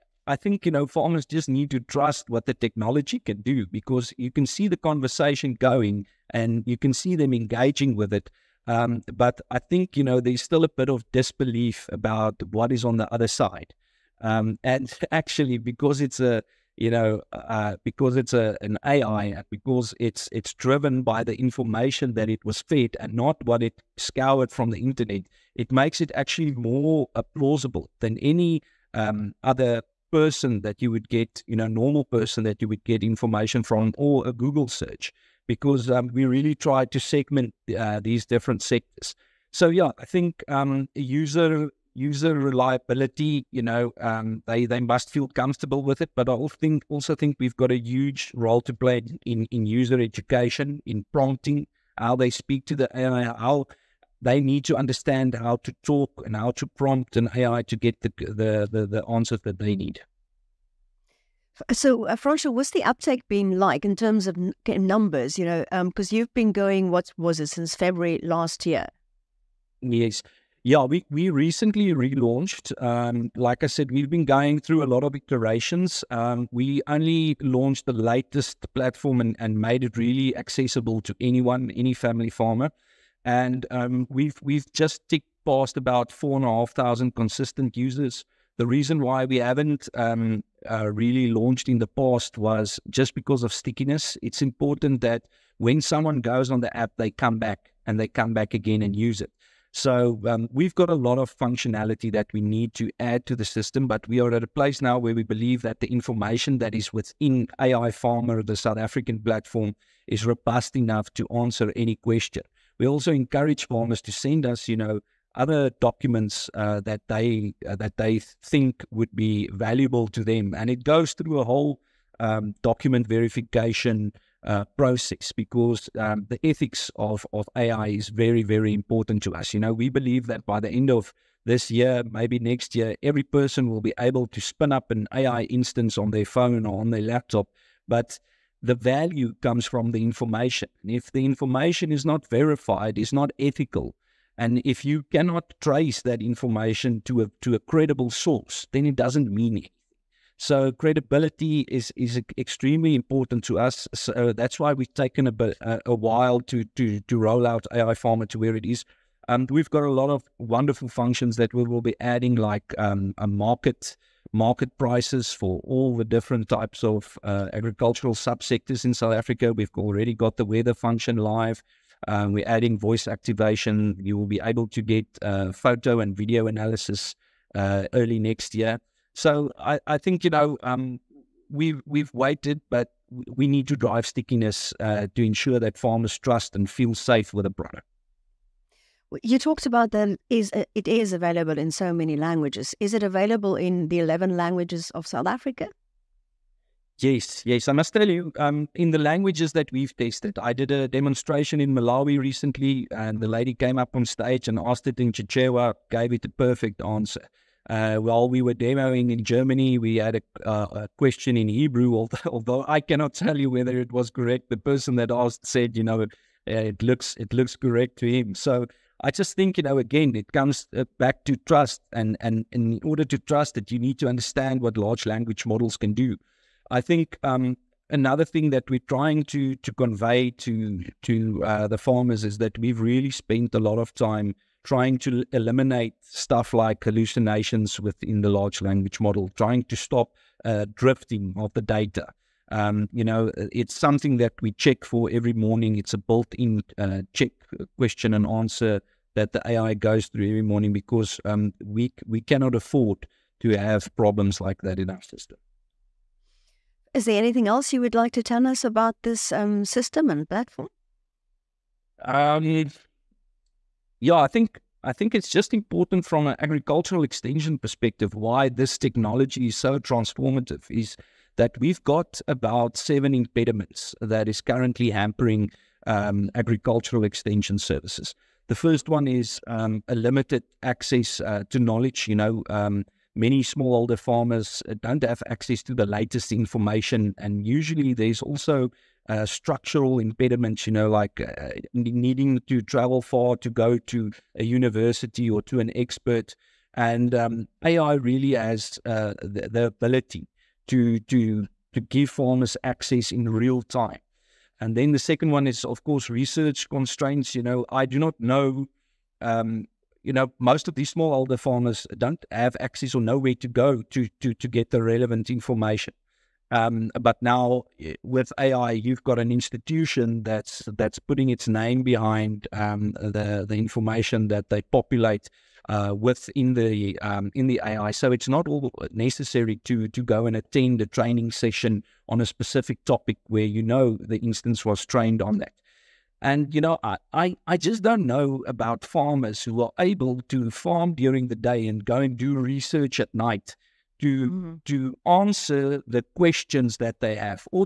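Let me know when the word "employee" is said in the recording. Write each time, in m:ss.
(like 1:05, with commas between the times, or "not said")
not said.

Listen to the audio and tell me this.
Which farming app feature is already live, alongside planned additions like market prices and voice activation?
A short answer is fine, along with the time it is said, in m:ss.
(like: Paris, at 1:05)
weather function, at 2:50.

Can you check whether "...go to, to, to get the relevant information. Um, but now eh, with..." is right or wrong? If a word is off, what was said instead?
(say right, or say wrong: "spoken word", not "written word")
right.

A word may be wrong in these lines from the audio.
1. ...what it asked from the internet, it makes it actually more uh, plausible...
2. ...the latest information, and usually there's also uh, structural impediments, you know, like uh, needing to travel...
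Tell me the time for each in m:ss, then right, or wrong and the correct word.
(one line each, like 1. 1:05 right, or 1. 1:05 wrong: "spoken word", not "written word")
1. 0:23 wrong: "scoured", not "asked"
2. 4:45 right.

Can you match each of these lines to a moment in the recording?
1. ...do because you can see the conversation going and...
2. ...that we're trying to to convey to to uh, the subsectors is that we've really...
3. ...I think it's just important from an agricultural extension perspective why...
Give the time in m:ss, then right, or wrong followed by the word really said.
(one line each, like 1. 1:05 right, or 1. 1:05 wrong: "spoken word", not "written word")
1. 0:03 right
2. 3:48 wrong: "farmers", not "subsectors"
3. 4:24 right.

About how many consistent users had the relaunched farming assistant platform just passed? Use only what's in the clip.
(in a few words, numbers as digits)
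4,500.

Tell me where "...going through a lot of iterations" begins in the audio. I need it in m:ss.
1:14.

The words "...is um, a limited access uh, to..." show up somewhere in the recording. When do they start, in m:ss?
4:39.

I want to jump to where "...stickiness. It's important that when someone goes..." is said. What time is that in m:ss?
1:33.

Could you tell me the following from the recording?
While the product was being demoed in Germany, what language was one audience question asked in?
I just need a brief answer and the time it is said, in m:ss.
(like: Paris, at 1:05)
Hebrew, at 3:31.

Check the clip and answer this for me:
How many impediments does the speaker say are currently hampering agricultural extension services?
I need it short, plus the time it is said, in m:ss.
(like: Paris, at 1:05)
7, at 4:32.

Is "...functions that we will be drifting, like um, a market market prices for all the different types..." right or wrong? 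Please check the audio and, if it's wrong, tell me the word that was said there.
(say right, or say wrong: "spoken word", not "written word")
wrong: "adding", not "drifting".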